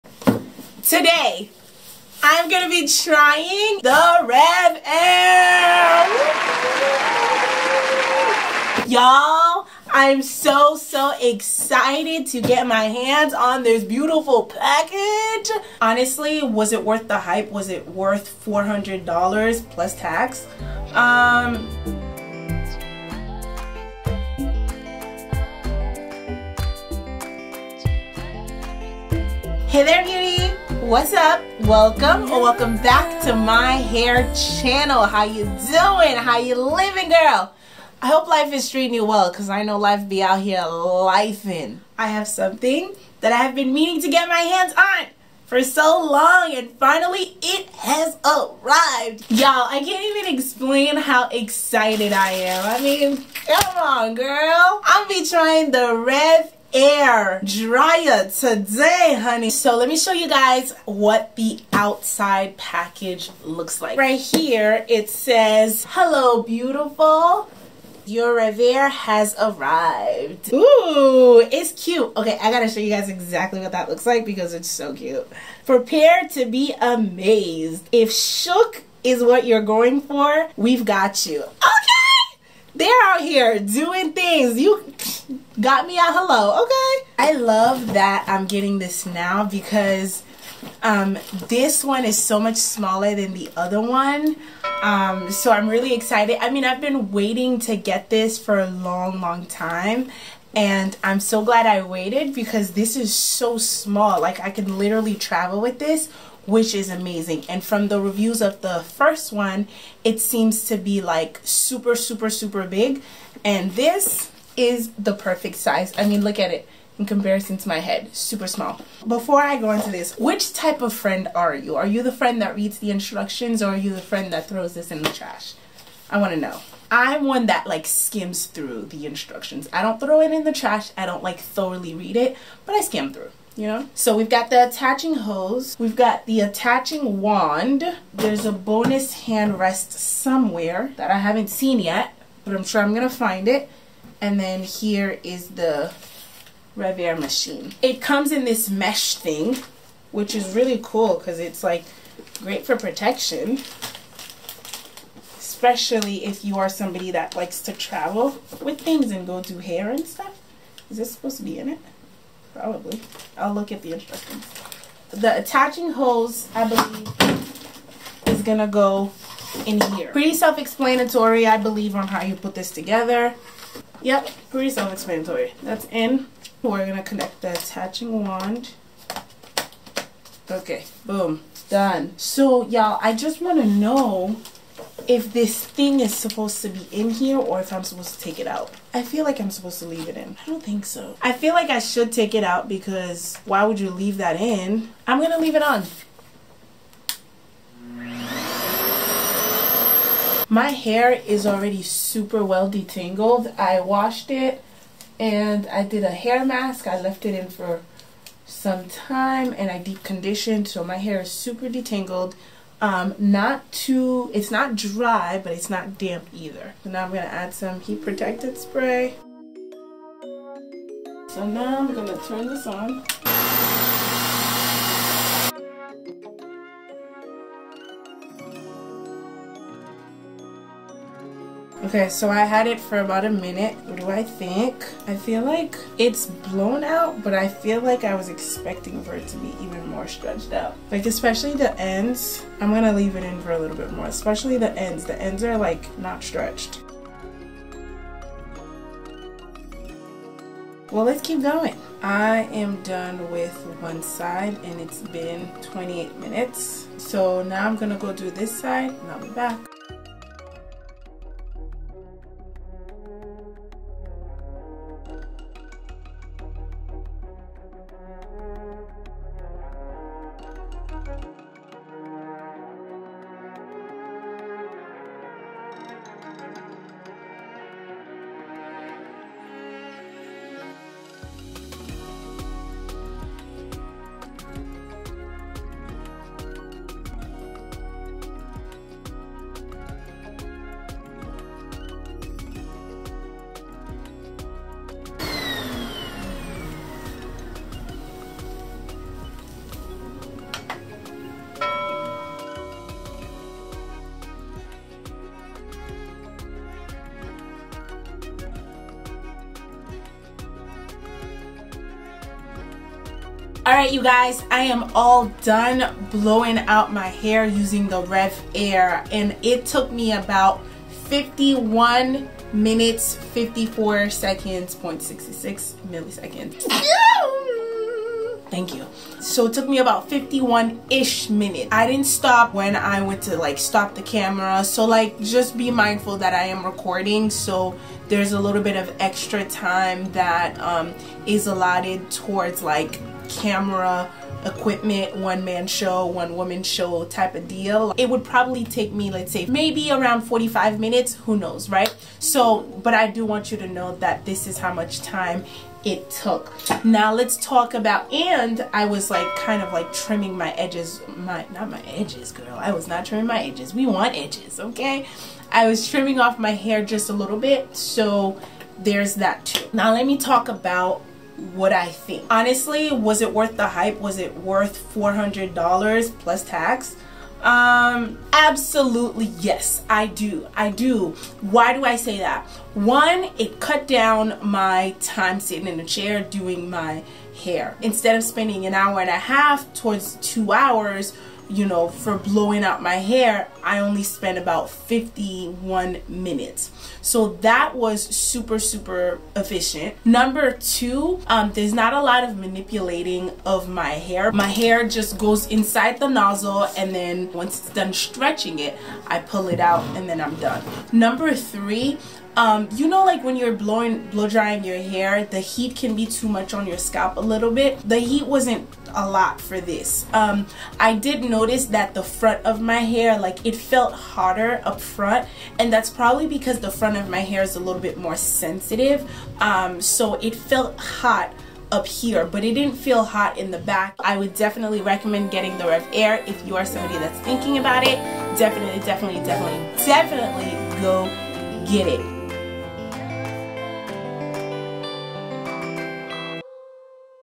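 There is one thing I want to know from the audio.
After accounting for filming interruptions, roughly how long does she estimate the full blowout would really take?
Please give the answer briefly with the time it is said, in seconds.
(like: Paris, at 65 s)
45 minutes, at 350 s.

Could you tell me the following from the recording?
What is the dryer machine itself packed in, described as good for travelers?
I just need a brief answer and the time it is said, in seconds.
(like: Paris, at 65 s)
Mesh thing, at 148 s.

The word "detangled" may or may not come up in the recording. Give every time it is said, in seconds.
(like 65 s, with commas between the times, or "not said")
202 s, 211 s.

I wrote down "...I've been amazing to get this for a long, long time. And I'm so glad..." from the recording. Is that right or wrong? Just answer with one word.
wrong.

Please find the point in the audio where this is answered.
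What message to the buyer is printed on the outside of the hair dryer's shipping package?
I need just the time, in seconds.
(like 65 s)
65 s.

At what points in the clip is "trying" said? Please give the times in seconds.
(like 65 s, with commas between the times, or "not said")
2 s, 55 s.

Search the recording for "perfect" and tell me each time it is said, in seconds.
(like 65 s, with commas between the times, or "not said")
115 s.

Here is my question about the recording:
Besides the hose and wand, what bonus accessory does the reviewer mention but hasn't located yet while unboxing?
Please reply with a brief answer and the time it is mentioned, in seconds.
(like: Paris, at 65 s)
Hand rest, at 139 s.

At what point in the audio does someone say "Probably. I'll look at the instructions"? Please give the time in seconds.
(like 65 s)
162 s.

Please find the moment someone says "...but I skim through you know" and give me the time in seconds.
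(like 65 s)
132 s.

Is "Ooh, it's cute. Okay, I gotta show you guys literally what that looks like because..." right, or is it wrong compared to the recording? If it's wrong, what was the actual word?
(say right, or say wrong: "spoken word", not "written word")
wrong: "exactly", not "literally".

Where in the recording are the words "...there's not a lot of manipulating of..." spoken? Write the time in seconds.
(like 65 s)
401 s.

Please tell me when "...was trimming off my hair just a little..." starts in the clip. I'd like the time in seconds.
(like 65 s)
365 s.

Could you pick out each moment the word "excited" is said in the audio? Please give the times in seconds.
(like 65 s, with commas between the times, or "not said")
11 s, 51 s, 95 s.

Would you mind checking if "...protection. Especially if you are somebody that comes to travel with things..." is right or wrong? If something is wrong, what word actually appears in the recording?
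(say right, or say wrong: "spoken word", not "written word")
wrong: "likes", not "comes".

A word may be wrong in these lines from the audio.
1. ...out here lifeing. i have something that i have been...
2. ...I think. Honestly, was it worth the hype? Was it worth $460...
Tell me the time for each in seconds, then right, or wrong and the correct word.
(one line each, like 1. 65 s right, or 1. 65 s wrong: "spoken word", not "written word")
1. 40 s right
2. 371 s wrong: "400", not "460".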